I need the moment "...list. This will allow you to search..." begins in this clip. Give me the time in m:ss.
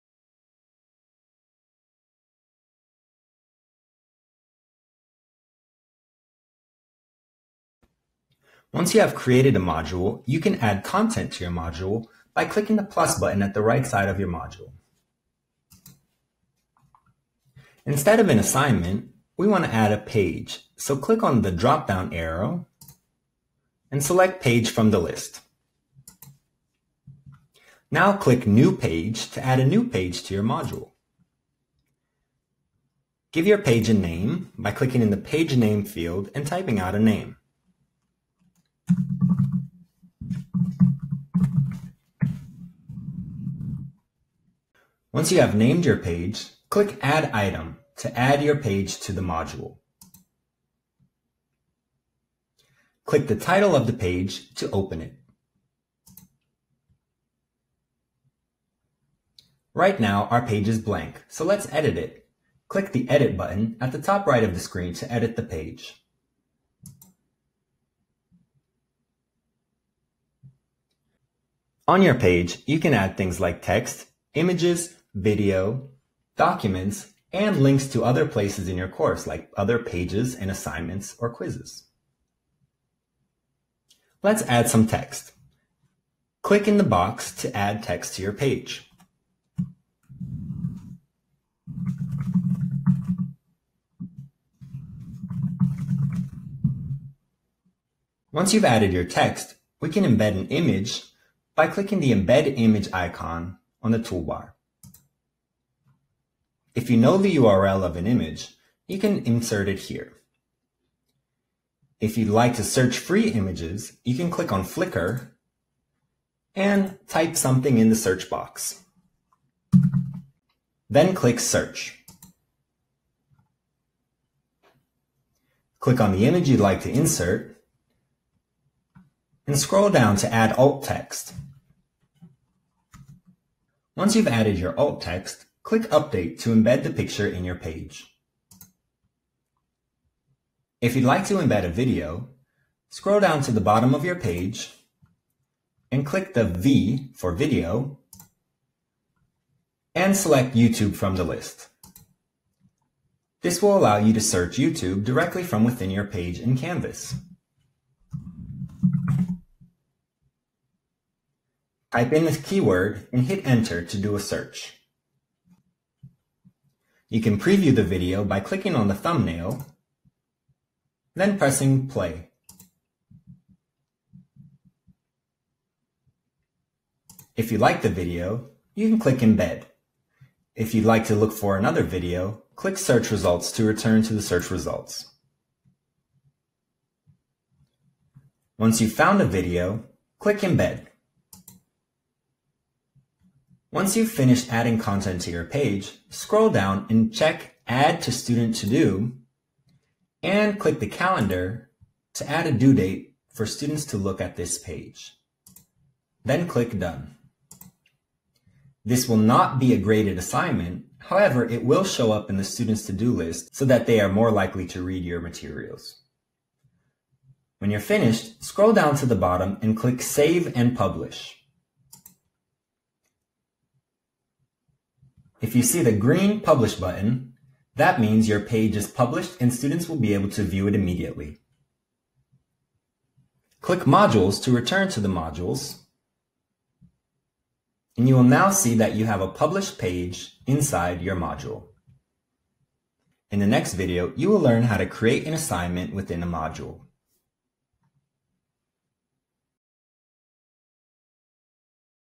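2:31.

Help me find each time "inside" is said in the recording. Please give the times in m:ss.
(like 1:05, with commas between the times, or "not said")
4:00.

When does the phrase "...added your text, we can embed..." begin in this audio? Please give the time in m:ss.
1:38.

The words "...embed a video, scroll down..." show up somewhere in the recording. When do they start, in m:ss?
2:21.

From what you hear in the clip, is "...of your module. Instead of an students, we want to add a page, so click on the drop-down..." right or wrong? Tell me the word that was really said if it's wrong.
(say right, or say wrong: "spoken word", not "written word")
wrong: "assignment", not "students".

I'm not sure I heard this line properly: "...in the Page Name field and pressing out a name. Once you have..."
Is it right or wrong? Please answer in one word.
wrong.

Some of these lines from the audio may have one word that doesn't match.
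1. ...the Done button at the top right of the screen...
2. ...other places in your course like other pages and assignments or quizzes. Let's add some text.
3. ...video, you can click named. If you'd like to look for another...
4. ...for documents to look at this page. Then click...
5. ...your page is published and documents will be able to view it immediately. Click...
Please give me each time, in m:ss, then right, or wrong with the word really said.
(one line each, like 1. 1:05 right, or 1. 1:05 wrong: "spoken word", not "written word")
1. 1:02 wrong: "Edit", not "Done"
2. 1:18 right
3. 2:57 wrong: "embed", not "named"
4. 3:23 wrong: "students", not "documents"
5. 3:48 wrong: "students", not "documents".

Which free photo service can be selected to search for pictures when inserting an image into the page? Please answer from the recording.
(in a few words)
Flickr.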